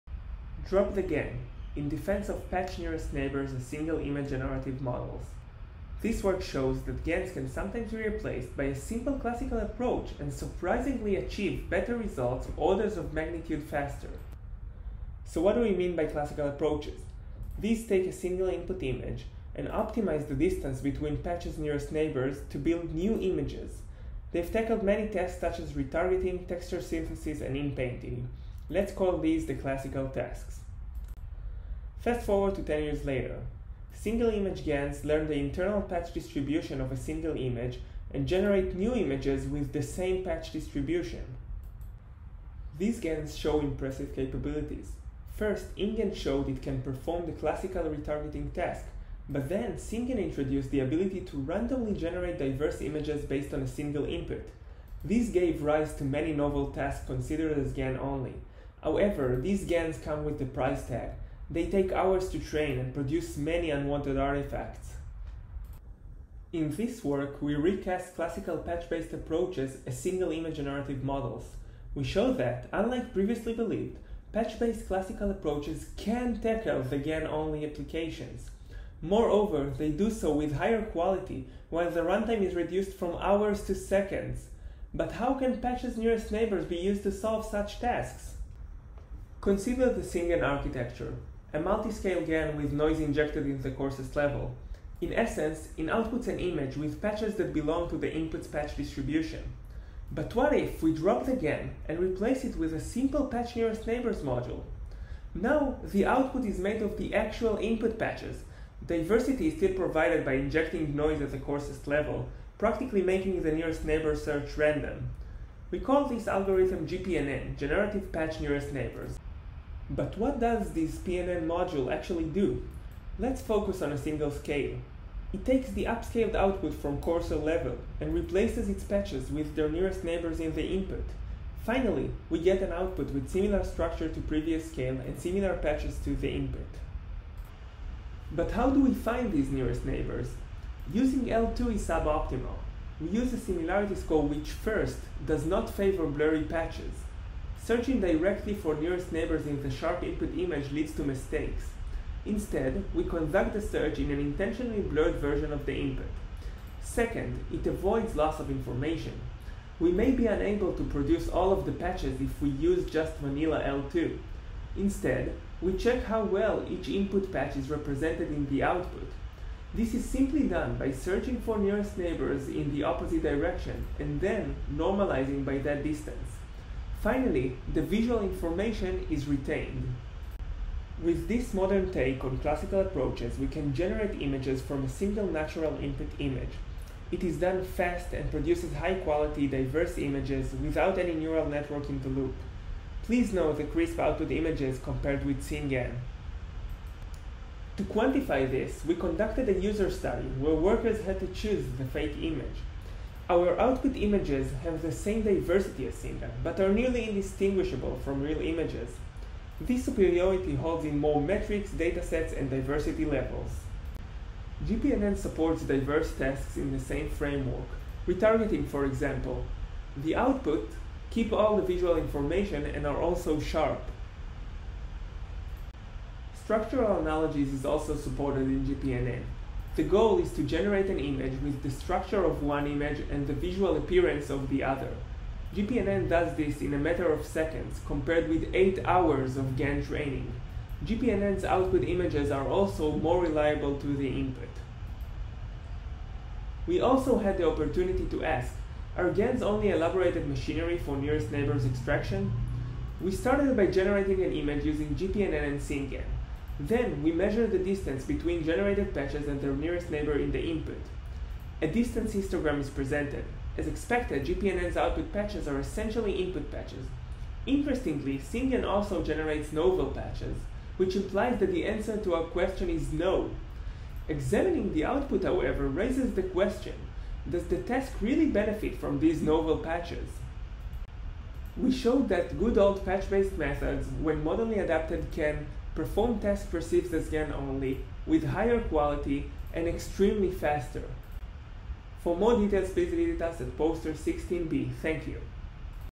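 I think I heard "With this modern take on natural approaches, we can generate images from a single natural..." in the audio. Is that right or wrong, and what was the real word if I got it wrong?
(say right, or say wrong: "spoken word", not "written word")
wrong: "classical", not "natural".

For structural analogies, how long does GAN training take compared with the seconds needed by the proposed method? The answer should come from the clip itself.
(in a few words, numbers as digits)
8 hours.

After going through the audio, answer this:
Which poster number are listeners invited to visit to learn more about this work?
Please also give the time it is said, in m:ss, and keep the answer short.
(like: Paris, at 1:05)
16b, at 4:53.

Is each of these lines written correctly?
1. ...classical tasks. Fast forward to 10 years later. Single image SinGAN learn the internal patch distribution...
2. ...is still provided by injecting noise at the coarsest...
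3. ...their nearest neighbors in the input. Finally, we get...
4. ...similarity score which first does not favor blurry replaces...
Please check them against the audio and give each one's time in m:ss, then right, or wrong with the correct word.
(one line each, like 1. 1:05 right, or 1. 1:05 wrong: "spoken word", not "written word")
1. 0:29 wrong: "GANs", not "SinGAN"
2. 1:49 right
3. 2:09 right
4. 2:23 wrong: "patches", not "replaces".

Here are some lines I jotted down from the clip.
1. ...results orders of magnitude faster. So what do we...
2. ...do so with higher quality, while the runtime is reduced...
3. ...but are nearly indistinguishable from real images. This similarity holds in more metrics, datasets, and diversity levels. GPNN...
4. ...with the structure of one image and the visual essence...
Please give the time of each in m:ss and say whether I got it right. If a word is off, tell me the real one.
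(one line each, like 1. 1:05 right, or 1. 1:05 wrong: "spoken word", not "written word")
1. 0:11 right
2. 1:19 right
3. 3:26 wrong: "superiority", not "similarity"
4. 3:51 wrong: "appearance", not "essence".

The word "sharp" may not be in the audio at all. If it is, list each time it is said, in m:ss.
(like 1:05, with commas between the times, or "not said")
2:29, 3:43.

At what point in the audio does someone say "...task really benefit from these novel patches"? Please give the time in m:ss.
4:37.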